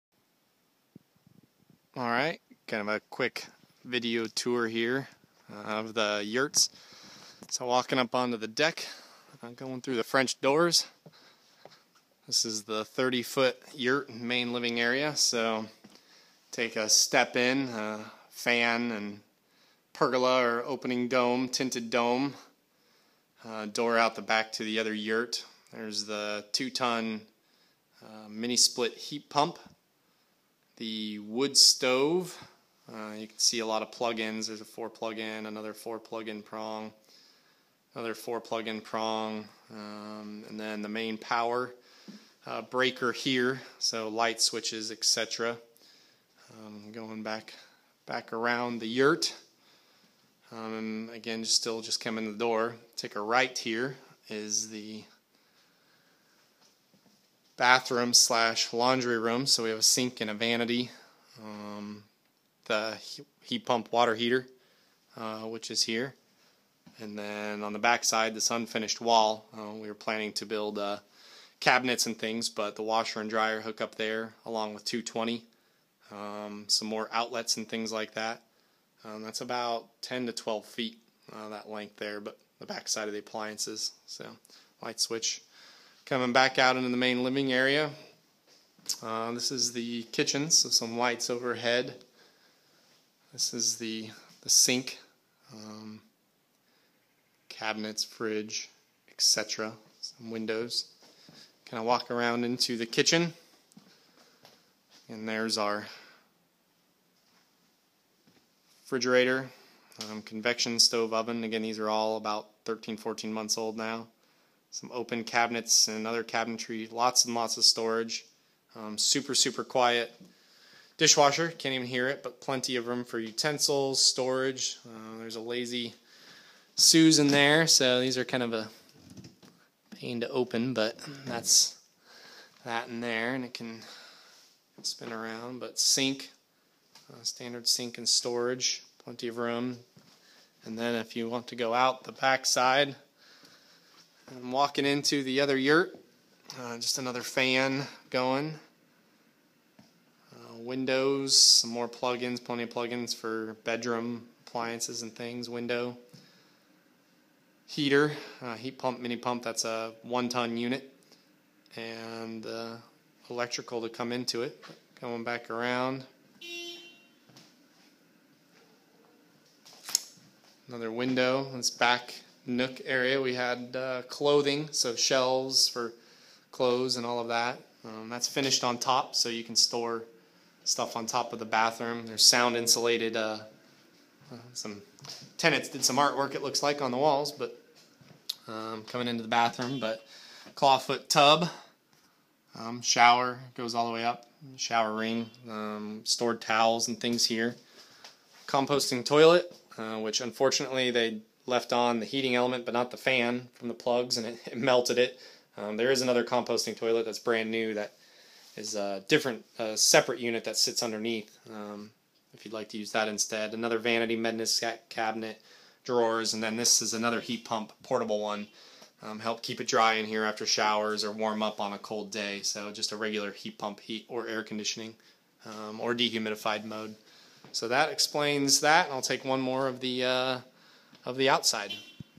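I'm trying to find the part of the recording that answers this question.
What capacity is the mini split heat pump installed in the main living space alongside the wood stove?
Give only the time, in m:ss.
0:26.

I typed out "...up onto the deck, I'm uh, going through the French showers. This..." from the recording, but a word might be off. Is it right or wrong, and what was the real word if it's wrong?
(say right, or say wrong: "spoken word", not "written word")
wrong: "doors", not "showers".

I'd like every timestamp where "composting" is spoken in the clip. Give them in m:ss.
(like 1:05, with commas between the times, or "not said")
3:18, 3:26.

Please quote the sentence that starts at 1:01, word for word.
Um, the heat pump water heater, uh, which is here.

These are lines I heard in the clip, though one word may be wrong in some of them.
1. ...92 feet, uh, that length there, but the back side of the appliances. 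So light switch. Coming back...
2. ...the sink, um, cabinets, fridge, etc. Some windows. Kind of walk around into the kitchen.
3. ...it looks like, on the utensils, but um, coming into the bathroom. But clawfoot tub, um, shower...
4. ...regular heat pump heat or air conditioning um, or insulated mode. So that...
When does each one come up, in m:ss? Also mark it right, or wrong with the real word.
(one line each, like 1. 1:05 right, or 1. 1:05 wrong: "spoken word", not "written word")
1. 1:20 wrong: "12", not "92"
2. 1:34 right
3. 3:06 wrong: "walls", not "utensils"
4. 3:42 wrong: "dehumidified", not "insulated".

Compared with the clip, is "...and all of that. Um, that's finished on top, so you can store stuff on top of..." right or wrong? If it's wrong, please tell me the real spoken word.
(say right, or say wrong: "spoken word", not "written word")
right.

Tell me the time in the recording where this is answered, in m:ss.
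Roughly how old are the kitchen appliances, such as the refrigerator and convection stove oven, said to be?
1:52.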